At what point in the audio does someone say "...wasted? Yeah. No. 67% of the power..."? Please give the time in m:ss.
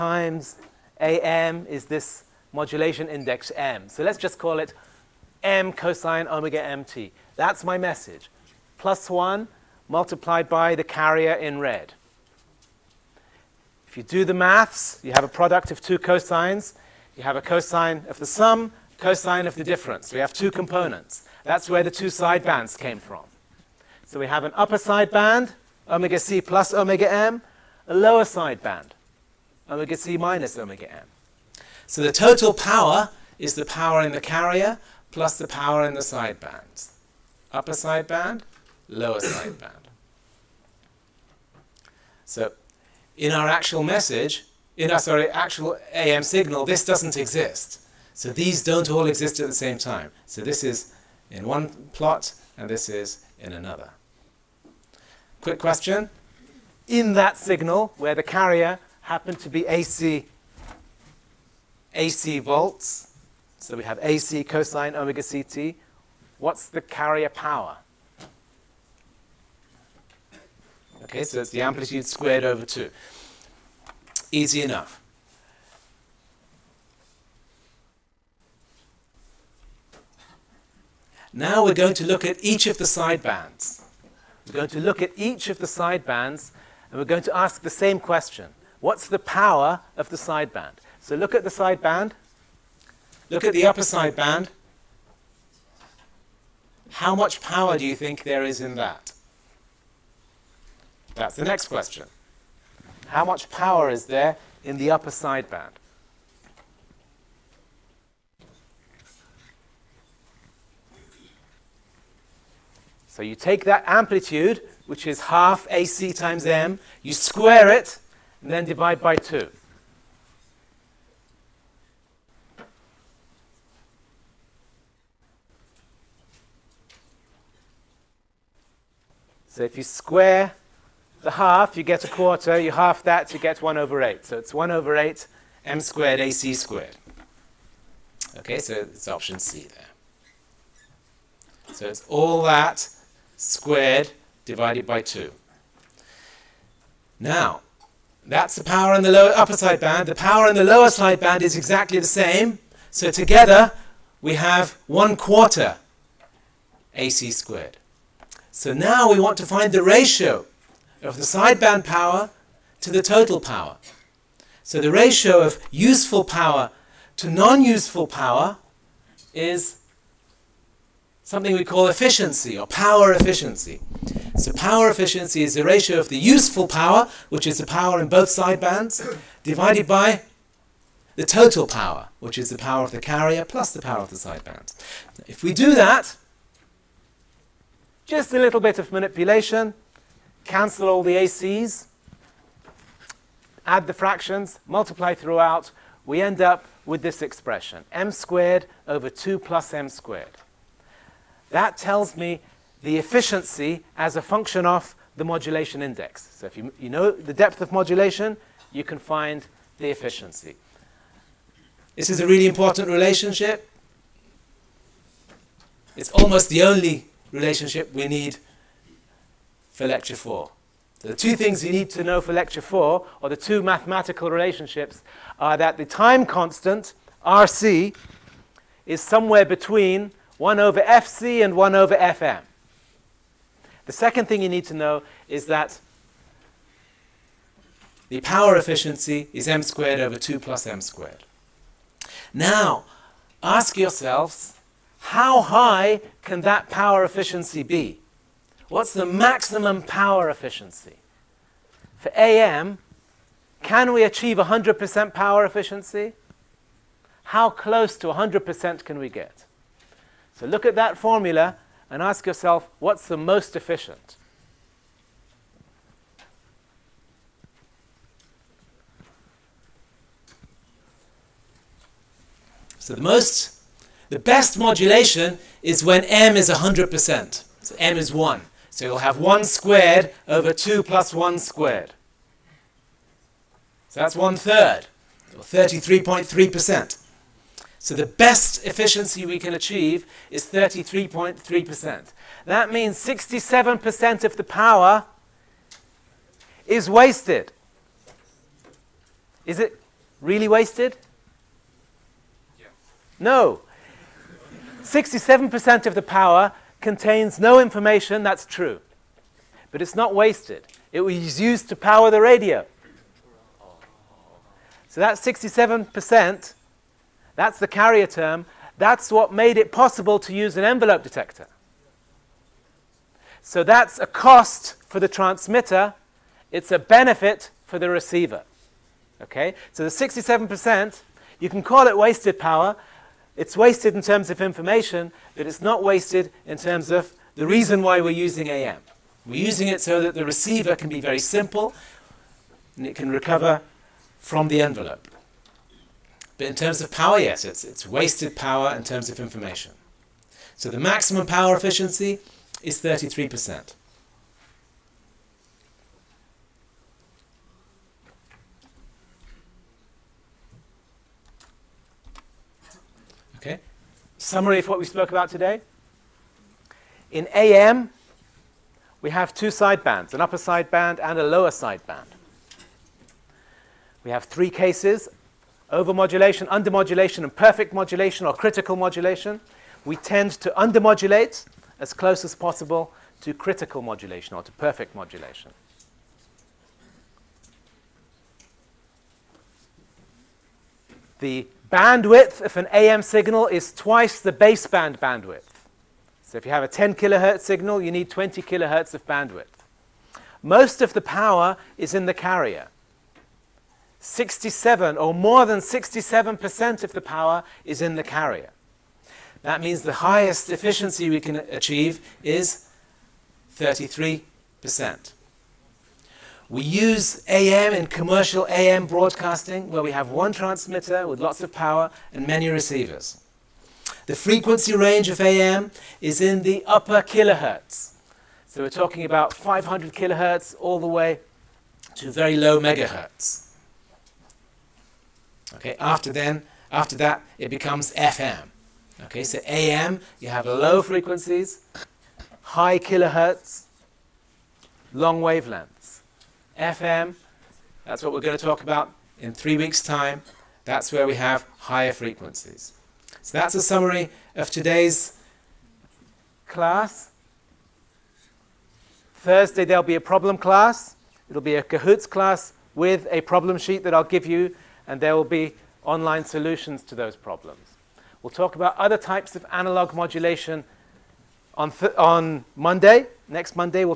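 5:00.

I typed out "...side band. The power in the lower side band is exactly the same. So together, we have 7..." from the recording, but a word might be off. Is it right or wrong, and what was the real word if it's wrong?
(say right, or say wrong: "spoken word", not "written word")
wrong: "1", not "7".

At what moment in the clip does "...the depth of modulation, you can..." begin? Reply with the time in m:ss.
3:27.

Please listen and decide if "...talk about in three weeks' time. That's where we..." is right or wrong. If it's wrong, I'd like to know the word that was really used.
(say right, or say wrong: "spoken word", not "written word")
right.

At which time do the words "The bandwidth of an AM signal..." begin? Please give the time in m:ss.
6:31.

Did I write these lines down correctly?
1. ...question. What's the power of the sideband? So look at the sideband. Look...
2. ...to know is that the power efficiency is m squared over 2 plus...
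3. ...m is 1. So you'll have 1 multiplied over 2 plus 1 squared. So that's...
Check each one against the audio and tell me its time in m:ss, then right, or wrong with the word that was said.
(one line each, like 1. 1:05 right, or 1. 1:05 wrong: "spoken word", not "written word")
1. 1:27 right
2. 3:54 right
3. 4:37 wrong: "squared", not "multiplied".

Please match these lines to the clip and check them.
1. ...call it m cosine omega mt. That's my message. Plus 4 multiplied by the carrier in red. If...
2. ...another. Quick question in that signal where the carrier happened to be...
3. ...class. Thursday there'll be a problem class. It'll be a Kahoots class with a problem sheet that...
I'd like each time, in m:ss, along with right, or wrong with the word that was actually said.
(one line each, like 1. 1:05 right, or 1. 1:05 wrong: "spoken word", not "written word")
1. 0:04 wrong: "1", not "4"
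2. 0:53 right
3. 7:36 right.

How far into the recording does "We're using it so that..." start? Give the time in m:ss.
5:39.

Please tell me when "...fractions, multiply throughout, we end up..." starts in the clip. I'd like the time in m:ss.
3:13.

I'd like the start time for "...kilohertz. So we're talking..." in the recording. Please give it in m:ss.
7:07.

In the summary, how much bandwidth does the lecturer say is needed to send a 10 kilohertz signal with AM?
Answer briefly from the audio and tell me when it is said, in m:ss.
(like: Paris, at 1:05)
20 kHz, at 6:38.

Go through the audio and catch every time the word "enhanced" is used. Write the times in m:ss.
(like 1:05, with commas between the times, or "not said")
not said.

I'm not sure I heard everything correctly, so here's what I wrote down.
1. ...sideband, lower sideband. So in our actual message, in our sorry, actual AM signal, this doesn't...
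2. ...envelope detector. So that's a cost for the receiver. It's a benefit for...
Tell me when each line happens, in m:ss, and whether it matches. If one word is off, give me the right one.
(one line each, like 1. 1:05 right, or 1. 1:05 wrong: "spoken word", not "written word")
1. 0:37 right
2. 5:20 wrong: "transmitter", not "receiver".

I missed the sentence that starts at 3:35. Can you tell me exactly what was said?
It's almost the only relationship we need for lecture four.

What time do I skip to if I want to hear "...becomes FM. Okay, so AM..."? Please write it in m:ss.
7:17.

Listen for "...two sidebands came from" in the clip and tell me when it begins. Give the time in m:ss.
0:21.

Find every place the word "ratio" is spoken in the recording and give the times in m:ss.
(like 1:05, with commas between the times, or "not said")
2:39, 2:44, 2:55.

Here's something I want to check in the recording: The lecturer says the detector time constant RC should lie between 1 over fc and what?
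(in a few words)
1 over fm.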